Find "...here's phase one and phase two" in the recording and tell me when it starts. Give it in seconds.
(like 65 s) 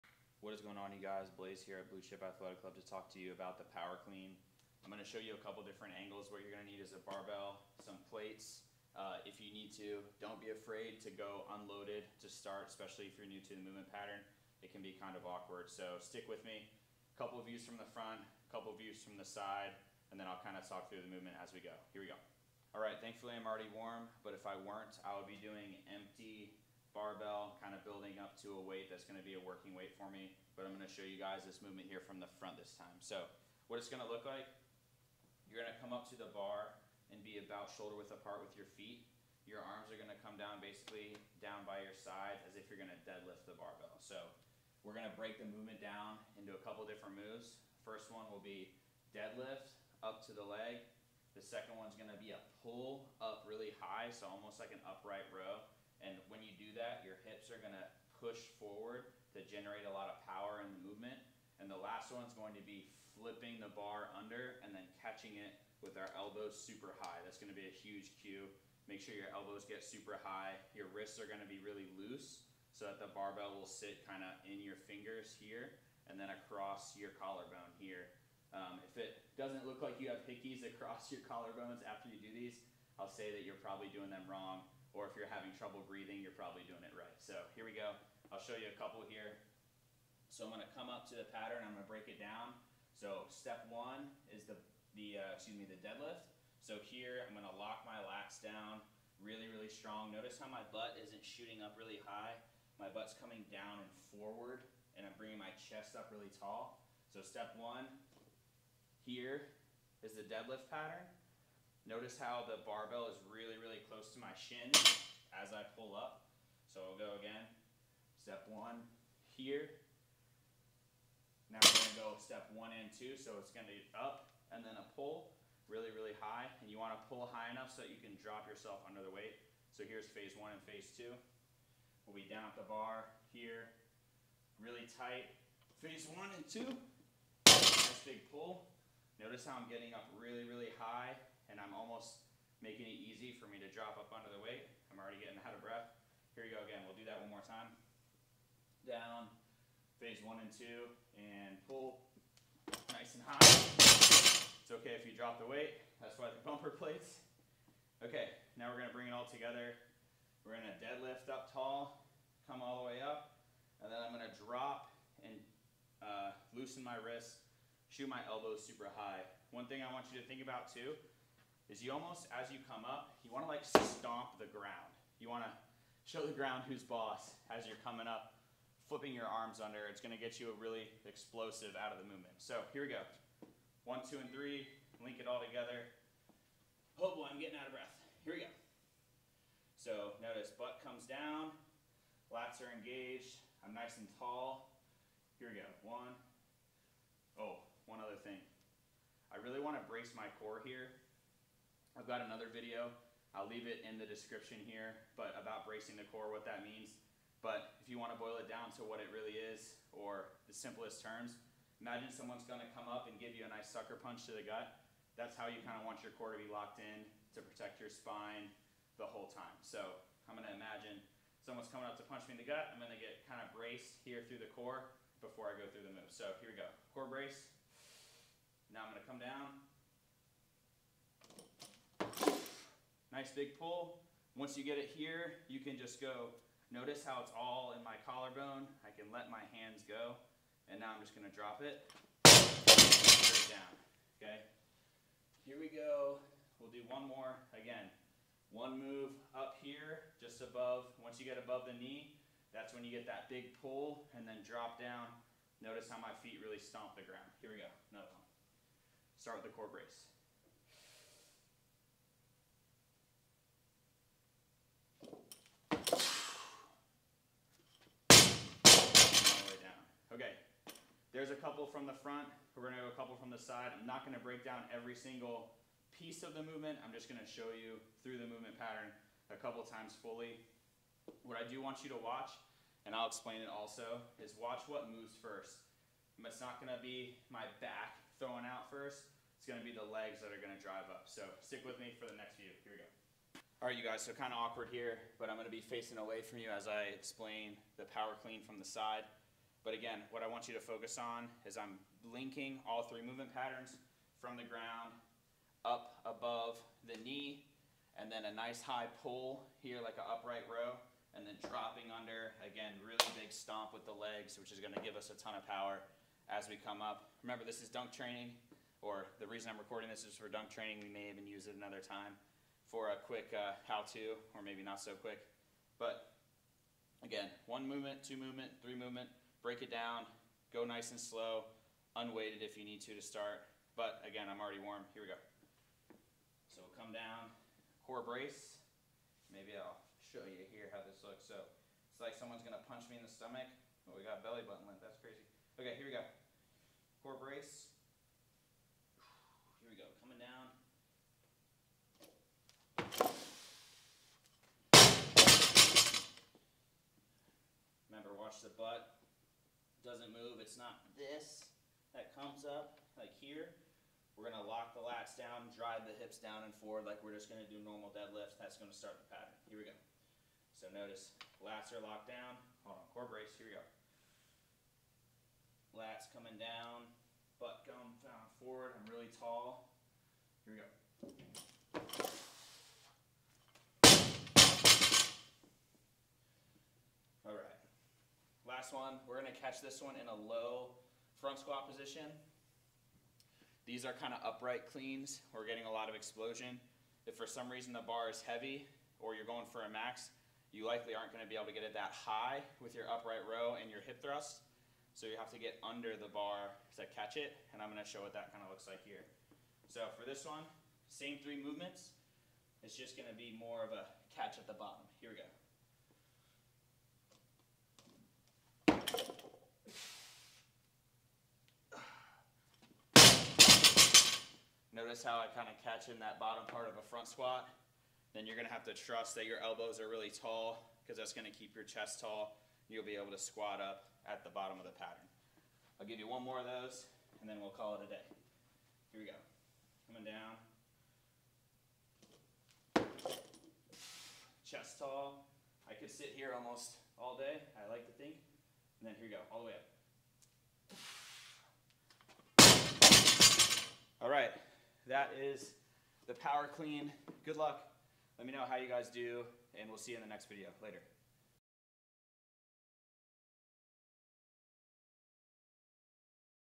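129 s.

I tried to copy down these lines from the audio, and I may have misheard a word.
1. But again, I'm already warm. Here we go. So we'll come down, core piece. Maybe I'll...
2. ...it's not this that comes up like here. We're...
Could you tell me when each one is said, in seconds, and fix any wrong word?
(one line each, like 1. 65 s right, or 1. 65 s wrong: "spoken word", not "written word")
1. 333 s wrong: "brace", not "piece"
2. 360 s right.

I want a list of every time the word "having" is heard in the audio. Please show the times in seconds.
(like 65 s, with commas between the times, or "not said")
85 s.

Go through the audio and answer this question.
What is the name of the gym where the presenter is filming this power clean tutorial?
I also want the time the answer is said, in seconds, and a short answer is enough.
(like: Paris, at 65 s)
Blue Chip Athletic Club, at 1 s.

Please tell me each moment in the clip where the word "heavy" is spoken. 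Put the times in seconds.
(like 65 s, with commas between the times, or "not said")
398 s.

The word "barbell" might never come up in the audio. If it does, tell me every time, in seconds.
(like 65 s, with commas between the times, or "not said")
7 s, 26 s, 43 s, 73 s, 112 s.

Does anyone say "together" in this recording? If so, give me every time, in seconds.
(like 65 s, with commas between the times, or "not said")
159 s, 185 s.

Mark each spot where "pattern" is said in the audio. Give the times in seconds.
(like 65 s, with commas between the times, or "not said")
13 s, 91 s, 110 s, 278 s, 303 s, 369 s, 434 s.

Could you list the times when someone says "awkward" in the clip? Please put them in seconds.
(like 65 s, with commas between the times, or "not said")
15 s, 294 s.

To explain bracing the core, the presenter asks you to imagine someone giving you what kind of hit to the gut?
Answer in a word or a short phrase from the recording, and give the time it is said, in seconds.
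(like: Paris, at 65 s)
sucker punch, at 213 s.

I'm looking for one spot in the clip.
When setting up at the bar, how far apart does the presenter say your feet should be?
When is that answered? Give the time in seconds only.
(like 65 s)
37 s.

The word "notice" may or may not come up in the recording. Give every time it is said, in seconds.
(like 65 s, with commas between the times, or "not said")
100 s, 111 s, 139 s, 190 s, 236 s, 255 s, 370 s, 424 s.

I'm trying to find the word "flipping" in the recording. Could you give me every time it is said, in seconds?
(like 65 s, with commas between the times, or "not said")
63 s, 178 s.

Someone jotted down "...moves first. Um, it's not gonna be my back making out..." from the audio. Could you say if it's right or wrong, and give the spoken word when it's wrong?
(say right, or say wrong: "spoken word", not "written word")
wrong: "throwing", not "making".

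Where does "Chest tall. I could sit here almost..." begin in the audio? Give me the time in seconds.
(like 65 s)
444 s.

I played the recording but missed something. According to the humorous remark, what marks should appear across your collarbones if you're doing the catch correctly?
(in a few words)
hickeys.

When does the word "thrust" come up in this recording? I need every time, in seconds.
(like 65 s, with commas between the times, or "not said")
403 s.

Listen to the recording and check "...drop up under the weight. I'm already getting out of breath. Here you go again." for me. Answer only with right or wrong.
right.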